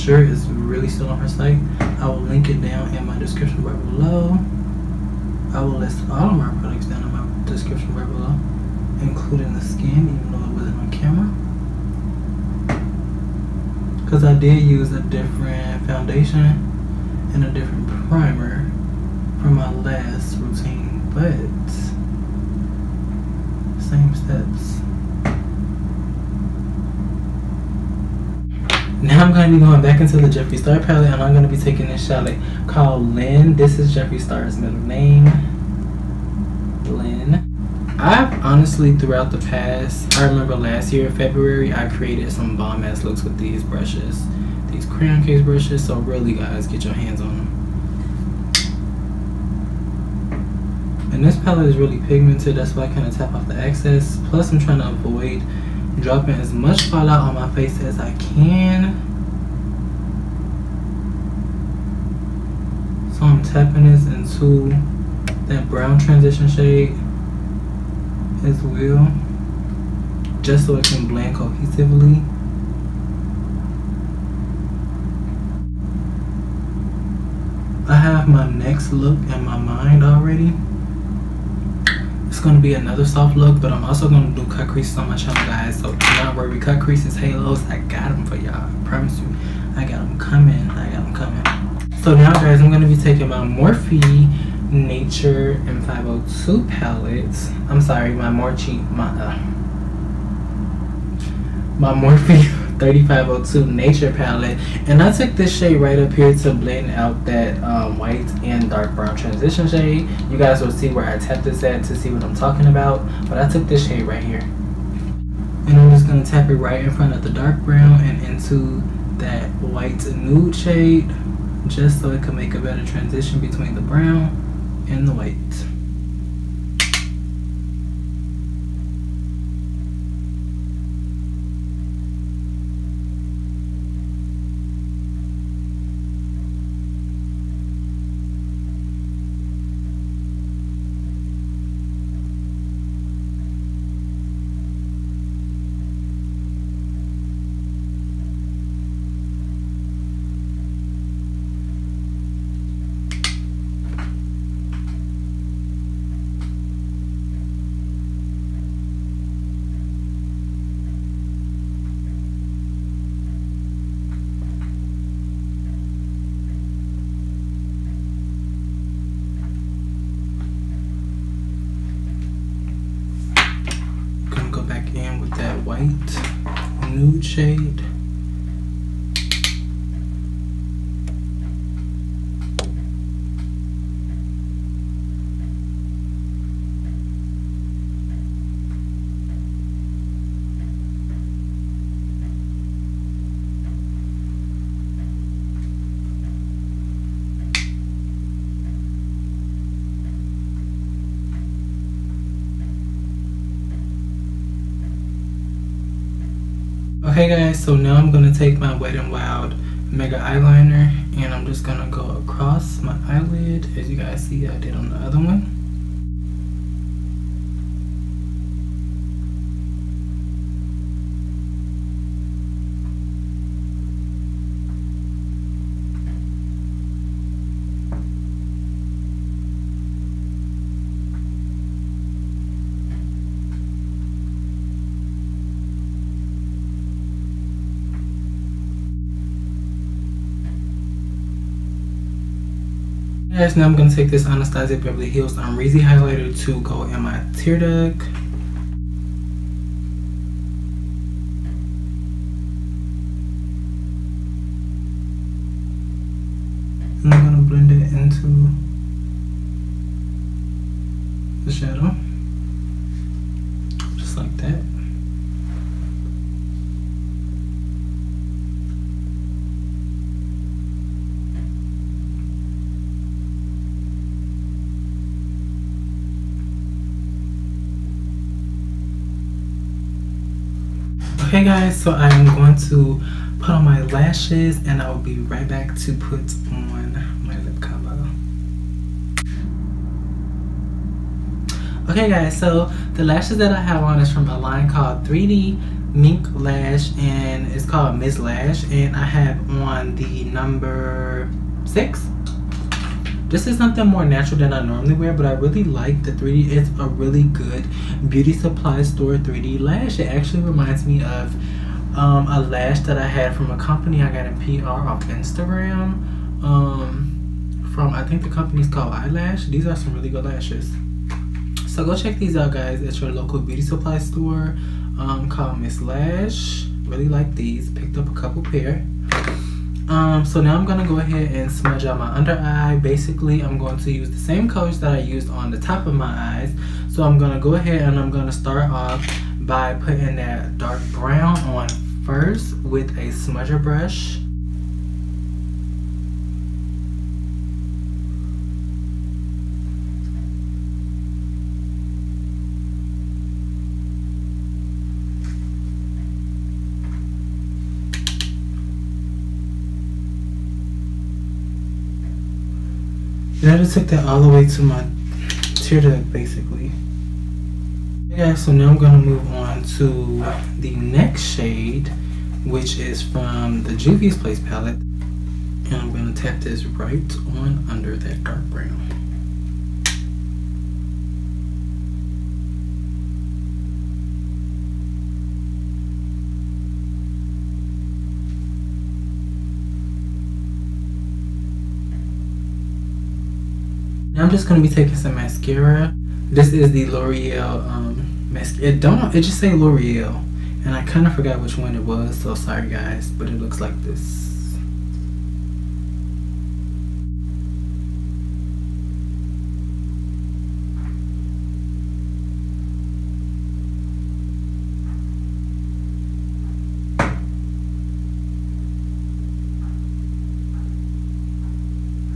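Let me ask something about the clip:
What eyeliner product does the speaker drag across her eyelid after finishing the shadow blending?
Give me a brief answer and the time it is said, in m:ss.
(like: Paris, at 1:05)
Wet n Wild Mega Eyeliner, at 3:28.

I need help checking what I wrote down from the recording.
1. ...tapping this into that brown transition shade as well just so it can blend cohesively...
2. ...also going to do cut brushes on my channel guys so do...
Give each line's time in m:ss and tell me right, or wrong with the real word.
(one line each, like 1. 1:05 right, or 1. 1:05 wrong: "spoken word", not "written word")
1. 1:03 right
2. 1:23 wrong: "creases", not "brushes".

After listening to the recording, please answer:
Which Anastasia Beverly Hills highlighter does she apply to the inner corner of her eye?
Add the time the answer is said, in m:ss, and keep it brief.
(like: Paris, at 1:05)
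Reezy, at 4:05.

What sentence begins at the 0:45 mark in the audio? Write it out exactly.
So, really, guys, get your hands on them.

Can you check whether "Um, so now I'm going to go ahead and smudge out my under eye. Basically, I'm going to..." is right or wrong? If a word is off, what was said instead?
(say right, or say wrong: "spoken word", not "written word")
right.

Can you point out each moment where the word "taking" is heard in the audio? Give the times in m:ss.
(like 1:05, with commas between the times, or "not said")
0:31, 1:32, 6:34.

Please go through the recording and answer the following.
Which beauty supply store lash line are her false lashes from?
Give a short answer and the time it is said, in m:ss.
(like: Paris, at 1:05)
3D Mink Lash, at 4:55.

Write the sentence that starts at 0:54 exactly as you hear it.
Plus, I'm trying to avoid dropping as much fallout on my face as I can.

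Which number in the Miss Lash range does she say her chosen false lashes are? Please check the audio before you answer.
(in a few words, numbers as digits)
6.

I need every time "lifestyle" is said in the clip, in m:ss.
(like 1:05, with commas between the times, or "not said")
not said.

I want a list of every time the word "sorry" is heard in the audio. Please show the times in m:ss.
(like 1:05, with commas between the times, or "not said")
1:37, 6:42.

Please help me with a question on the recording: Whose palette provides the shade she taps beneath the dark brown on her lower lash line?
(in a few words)
Juvia's Place.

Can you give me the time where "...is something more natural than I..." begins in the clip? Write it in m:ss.
5:03.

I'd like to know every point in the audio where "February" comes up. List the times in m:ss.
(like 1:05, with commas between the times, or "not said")
0:41.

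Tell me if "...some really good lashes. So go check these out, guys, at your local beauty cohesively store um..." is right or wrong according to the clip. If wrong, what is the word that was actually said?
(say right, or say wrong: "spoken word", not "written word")
wrong: "supply", not "cohesively".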